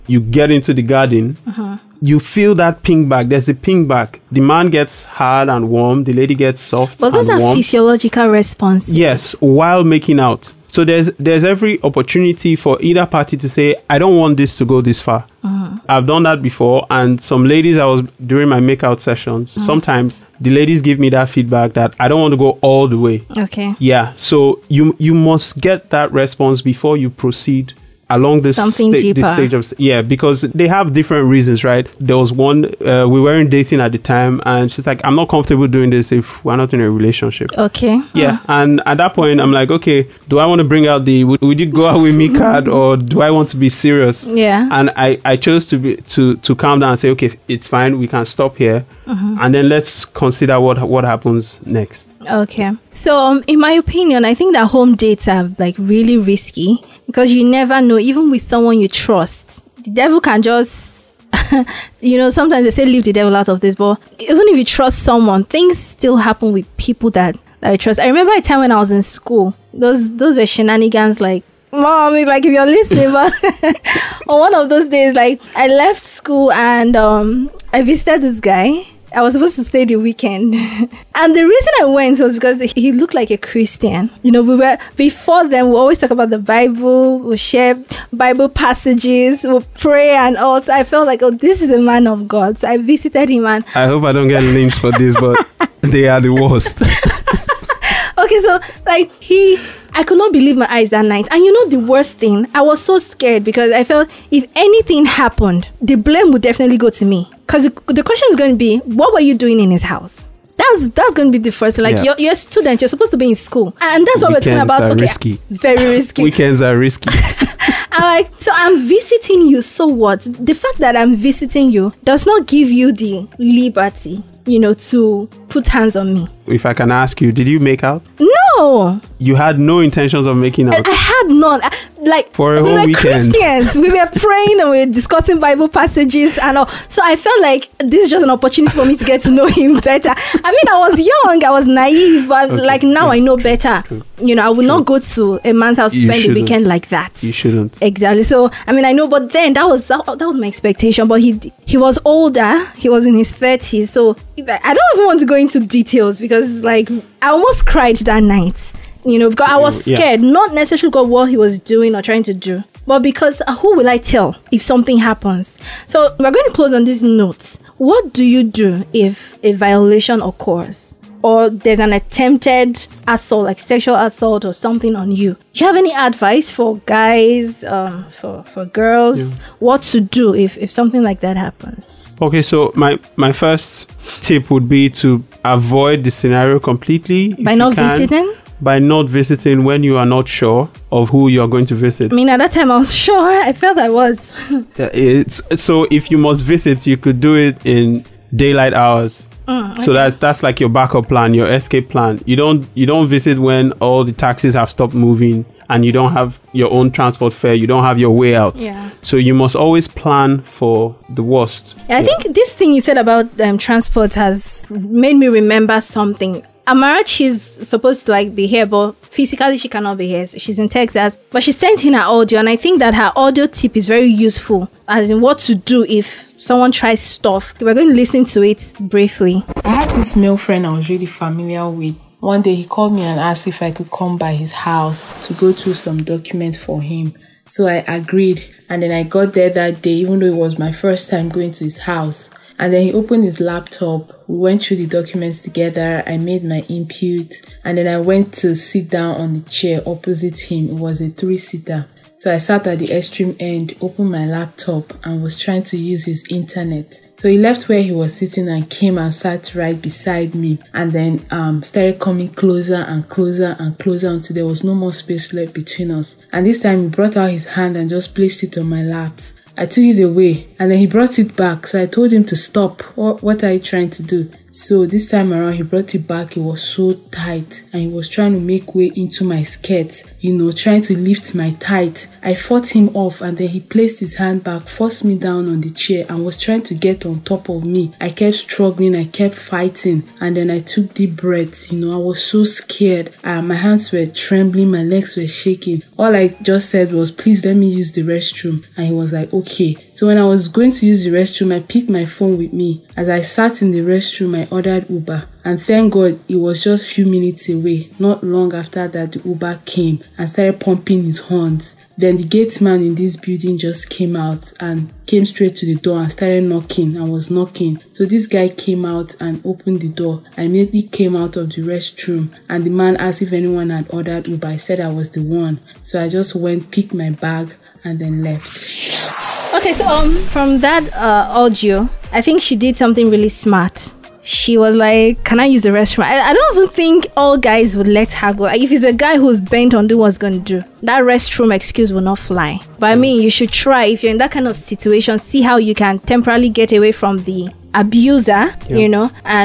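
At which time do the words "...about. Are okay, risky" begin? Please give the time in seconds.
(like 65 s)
114 s.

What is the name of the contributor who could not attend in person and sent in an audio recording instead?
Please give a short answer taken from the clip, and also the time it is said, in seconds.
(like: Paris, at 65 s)
Amarachi, at 216 s.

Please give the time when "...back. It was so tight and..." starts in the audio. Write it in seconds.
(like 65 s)
276 s.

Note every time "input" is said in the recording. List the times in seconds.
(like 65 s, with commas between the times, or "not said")
246 s.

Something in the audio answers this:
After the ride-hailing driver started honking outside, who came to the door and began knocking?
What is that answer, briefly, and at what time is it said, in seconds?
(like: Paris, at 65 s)
The gate man, at 312 s.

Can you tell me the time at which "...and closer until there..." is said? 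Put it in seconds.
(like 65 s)
263 s.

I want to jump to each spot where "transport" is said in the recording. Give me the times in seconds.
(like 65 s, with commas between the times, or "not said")
206 s, 213 s.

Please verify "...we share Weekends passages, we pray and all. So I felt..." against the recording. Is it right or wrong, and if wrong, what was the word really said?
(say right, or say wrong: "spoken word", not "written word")
wrong: "Bible", not "Weekends".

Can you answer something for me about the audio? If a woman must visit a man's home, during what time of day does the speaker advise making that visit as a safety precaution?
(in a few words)
Daylight hours.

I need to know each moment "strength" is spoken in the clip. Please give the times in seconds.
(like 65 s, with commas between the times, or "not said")
not said.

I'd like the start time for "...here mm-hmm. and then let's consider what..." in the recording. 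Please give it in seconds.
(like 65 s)
48 s.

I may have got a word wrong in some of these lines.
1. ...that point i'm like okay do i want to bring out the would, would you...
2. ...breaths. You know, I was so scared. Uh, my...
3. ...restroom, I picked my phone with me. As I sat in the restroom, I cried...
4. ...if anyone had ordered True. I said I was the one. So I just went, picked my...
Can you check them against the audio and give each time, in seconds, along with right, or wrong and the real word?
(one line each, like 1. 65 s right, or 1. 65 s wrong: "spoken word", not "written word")
1. 38 s right
2. 291 s right
3. 301 s wrong: "ordered", not "cried"
4. 323 s wrong: "Uber", not "True".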